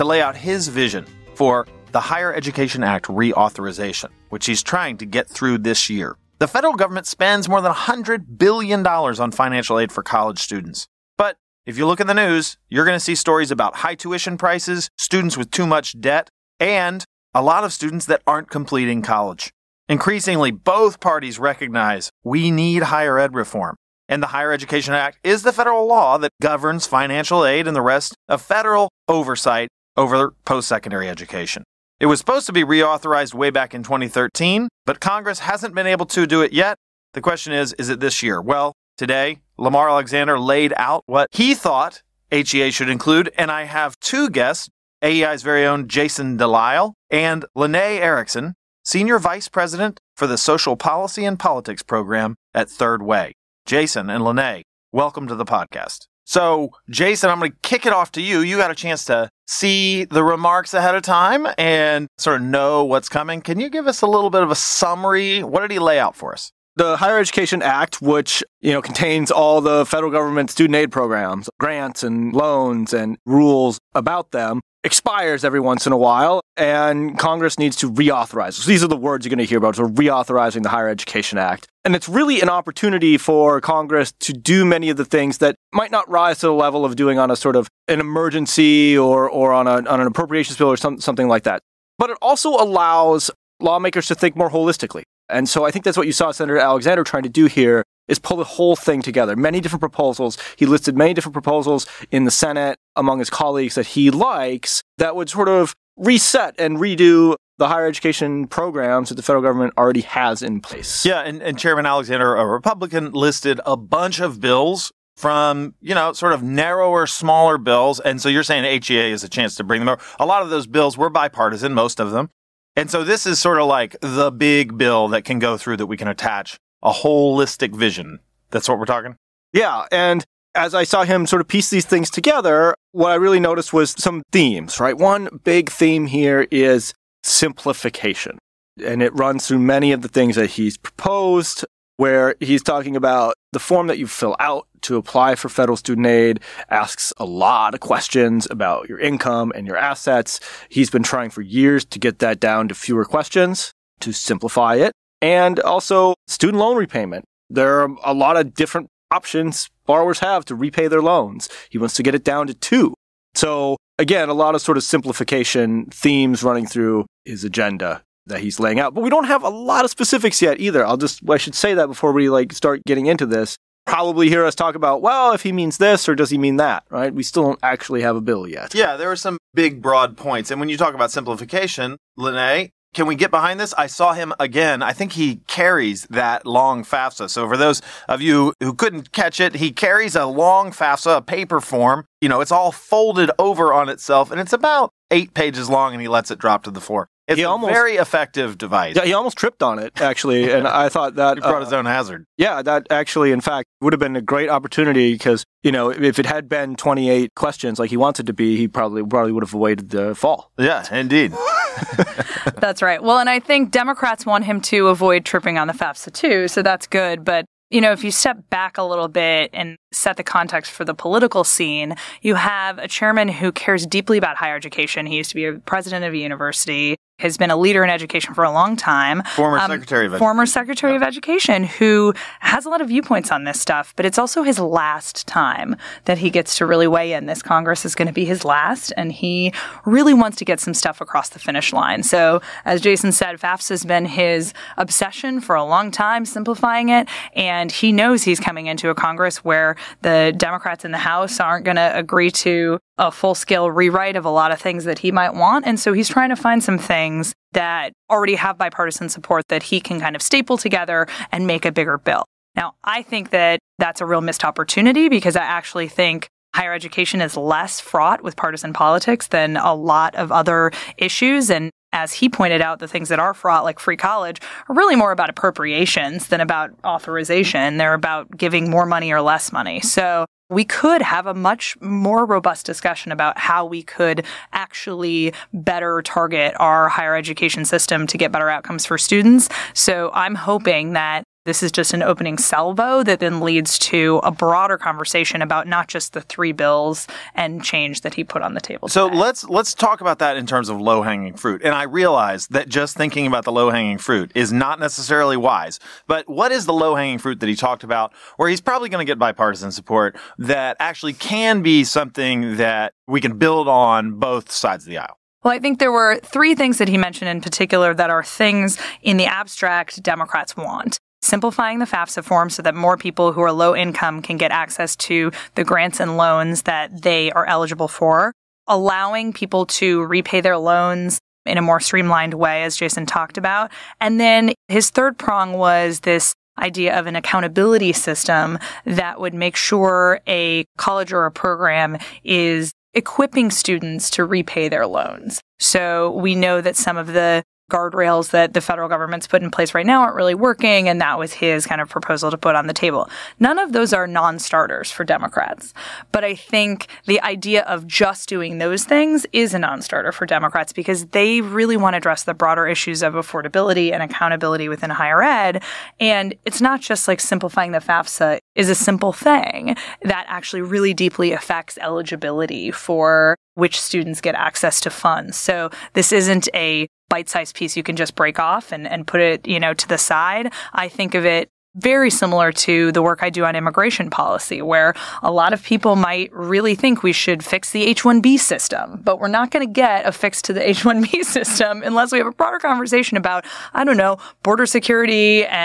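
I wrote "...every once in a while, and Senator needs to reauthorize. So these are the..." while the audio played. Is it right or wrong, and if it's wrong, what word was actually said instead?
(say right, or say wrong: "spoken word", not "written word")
wrong: "Congress", not "Senator".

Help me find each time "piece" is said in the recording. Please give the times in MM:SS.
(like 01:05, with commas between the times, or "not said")
02:11, 06:17.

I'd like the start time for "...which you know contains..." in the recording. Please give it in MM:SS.
01:08.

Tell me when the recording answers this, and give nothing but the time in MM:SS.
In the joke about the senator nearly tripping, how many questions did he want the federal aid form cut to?
03:26.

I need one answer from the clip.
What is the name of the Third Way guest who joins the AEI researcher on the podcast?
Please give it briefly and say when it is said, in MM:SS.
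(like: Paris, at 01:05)
Lanae Erickson, at 00:47.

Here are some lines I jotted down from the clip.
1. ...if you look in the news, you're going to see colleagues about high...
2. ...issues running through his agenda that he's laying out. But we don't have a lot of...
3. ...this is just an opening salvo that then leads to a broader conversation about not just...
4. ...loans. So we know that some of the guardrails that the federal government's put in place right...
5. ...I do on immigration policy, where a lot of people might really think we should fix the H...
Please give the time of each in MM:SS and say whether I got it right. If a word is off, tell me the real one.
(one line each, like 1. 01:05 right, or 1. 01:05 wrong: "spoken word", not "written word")
1. 00:11 wrong: "stories", not "colleagues"
2. 02:45 wrong: "themes", not "issues"
3. 04:51 right
4. 05:44 right
5. 06:23 right.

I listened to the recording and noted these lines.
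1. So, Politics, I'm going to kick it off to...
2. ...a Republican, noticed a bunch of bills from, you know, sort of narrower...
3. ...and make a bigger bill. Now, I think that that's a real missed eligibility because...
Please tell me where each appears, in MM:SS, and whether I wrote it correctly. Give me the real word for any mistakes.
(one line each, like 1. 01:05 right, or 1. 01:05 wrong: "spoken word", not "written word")
1. 00:56 wrong: "Jason", not "Politics"
2. 01:52 wrong: "listed", not "noticed"
3. 04:21 wrong: "opportunity", not "eligibility".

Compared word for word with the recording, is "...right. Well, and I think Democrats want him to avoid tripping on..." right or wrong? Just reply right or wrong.
right.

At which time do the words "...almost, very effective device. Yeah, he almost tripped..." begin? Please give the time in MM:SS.
03:17.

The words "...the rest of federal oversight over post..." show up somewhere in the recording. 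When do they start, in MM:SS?
00:27.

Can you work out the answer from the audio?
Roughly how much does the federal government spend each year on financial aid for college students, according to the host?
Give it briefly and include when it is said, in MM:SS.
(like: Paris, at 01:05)
more than $100 billion, at 00:07.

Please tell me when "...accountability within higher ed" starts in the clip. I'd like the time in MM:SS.
06:04.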